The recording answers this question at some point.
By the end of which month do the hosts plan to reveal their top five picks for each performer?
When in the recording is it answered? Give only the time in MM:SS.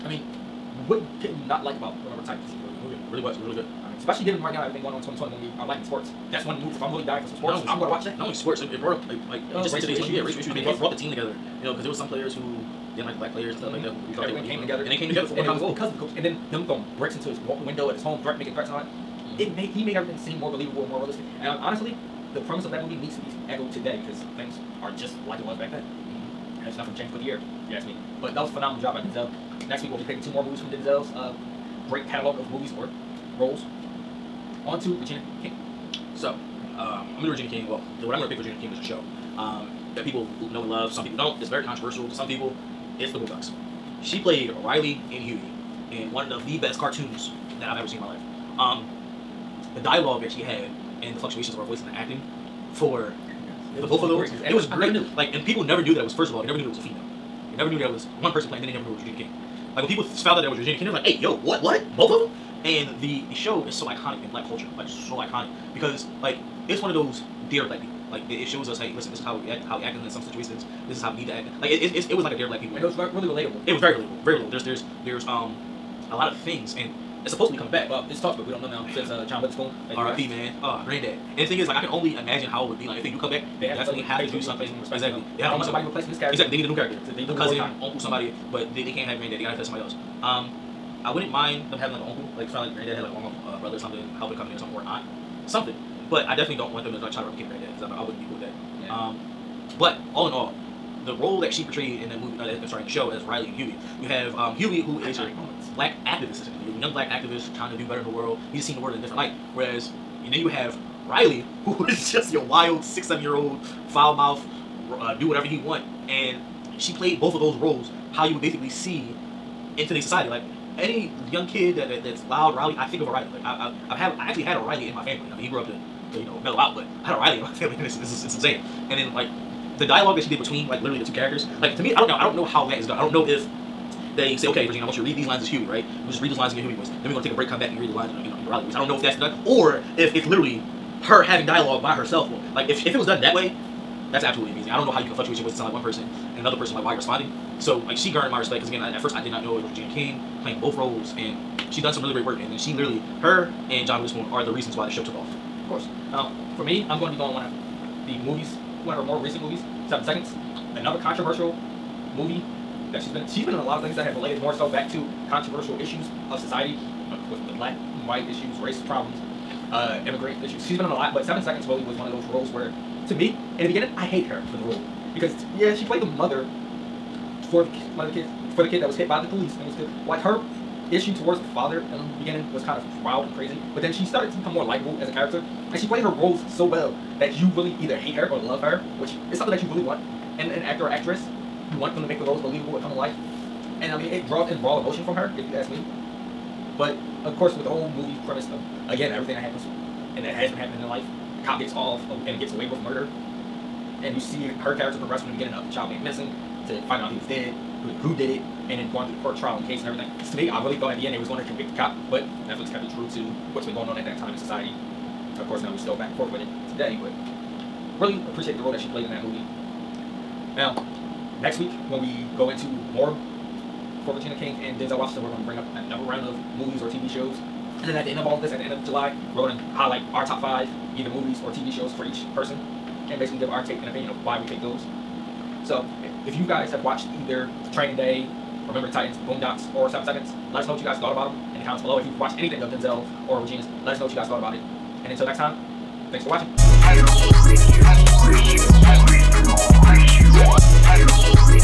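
03:48.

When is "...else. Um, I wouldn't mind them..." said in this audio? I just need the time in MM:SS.
01:29.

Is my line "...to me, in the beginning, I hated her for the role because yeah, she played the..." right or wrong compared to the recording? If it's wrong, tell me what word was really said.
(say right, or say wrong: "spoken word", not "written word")
right.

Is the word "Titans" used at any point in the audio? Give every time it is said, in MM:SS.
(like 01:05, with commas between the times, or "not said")
00:02, 03:58.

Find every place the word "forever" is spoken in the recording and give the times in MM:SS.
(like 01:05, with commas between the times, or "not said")
not said.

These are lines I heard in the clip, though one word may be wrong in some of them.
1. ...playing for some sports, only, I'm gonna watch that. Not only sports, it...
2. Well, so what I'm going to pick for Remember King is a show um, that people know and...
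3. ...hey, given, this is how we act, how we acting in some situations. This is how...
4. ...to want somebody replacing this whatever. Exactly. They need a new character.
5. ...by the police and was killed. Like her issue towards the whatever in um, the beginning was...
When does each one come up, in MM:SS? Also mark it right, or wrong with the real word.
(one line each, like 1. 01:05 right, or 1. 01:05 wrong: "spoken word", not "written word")
1. 00:07 wrong: "dying", not "playing"
2. 00:37 wrong: "Regina", not "Remember"
3. 01:08 wrong: "listen", not "given"
4. 01:25 wrong: "character", not "whatever"
5. 02:59 wrong: "father", not "whatever".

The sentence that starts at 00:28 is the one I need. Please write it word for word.
But that was a phenomenal job by Denzel.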